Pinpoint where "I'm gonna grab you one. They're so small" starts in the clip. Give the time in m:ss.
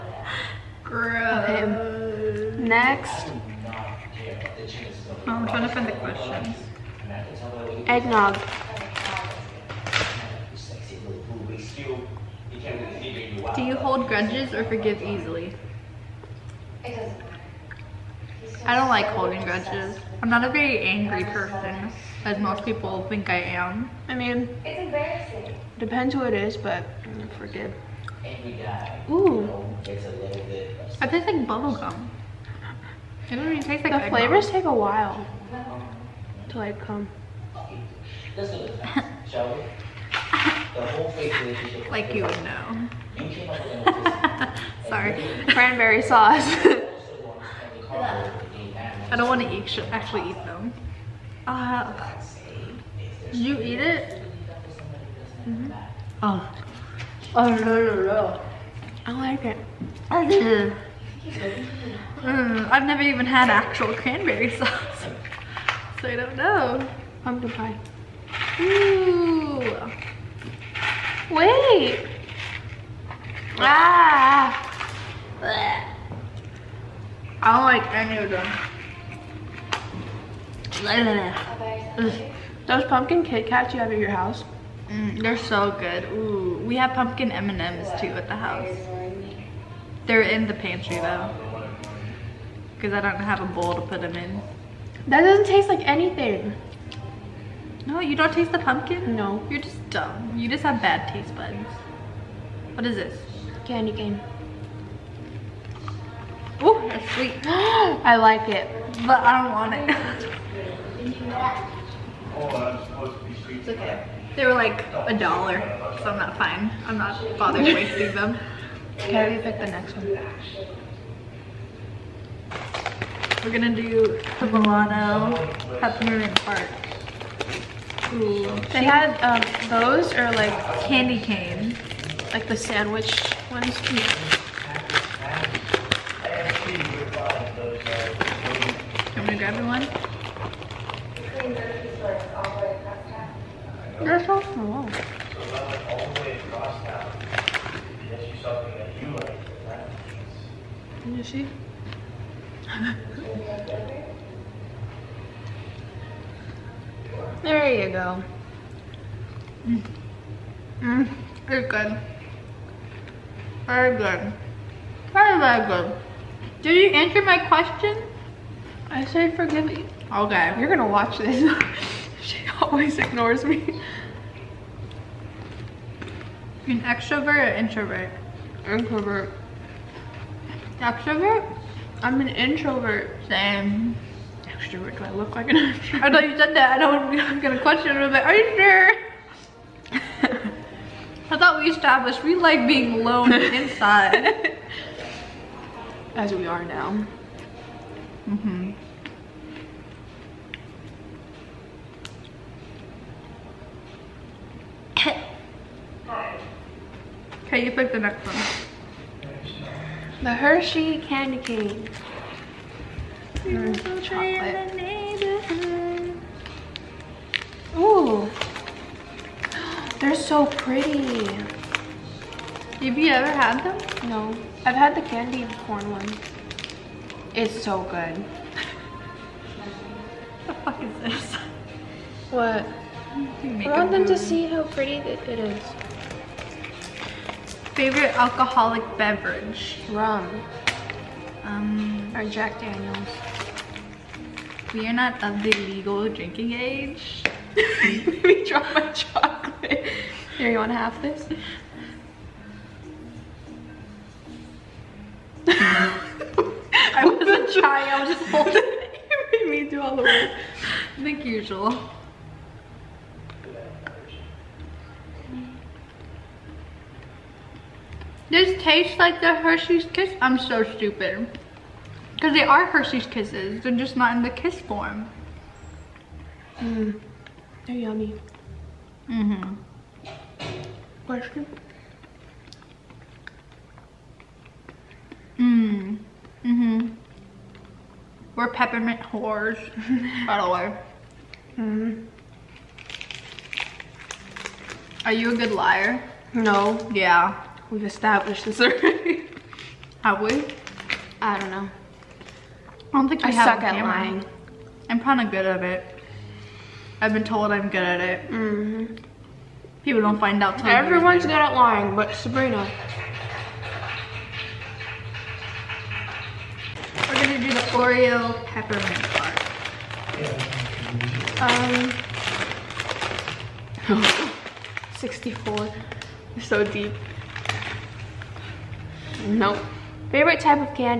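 2:19.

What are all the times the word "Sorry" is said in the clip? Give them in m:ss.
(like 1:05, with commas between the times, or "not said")
0:44.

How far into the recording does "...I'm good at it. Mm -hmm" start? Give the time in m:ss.
5:07.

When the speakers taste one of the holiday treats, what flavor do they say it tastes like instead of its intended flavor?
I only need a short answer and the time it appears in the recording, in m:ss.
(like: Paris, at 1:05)
Bubble gum, at 0:31.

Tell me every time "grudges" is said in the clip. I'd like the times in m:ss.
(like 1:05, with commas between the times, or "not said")
0:14, 0:19.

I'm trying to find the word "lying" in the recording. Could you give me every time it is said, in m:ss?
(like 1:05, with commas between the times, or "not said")
5:03, 5:11.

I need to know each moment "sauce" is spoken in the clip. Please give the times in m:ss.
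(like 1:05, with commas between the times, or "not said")
0:46, 1:04.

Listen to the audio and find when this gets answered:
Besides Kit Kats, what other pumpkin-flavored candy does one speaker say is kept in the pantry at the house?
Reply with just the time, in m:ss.
1:26.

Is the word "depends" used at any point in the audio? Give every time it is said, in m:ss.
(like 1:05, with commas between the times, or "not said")
0:25.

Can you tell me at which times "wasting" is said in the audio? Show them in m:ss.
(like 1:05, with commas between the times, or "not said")
1:57.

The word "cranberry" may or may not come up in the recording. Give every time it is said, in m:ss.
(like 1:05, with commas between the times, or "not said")
0:45, 1:03.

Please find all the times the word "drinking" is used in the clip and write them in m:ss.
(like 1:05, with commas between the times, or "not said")
4:06.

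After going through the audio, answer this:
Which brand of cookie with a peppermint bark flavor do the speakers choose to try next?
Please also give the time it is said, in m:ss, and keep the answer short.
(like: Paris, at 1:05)
Milano, at 2:04.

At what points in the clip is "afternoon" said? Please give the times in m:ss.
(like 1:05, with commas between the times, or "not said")
not said.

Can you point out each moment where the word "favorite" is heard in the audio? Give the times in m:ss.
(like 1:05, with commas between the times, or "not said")
3:57, 5:30.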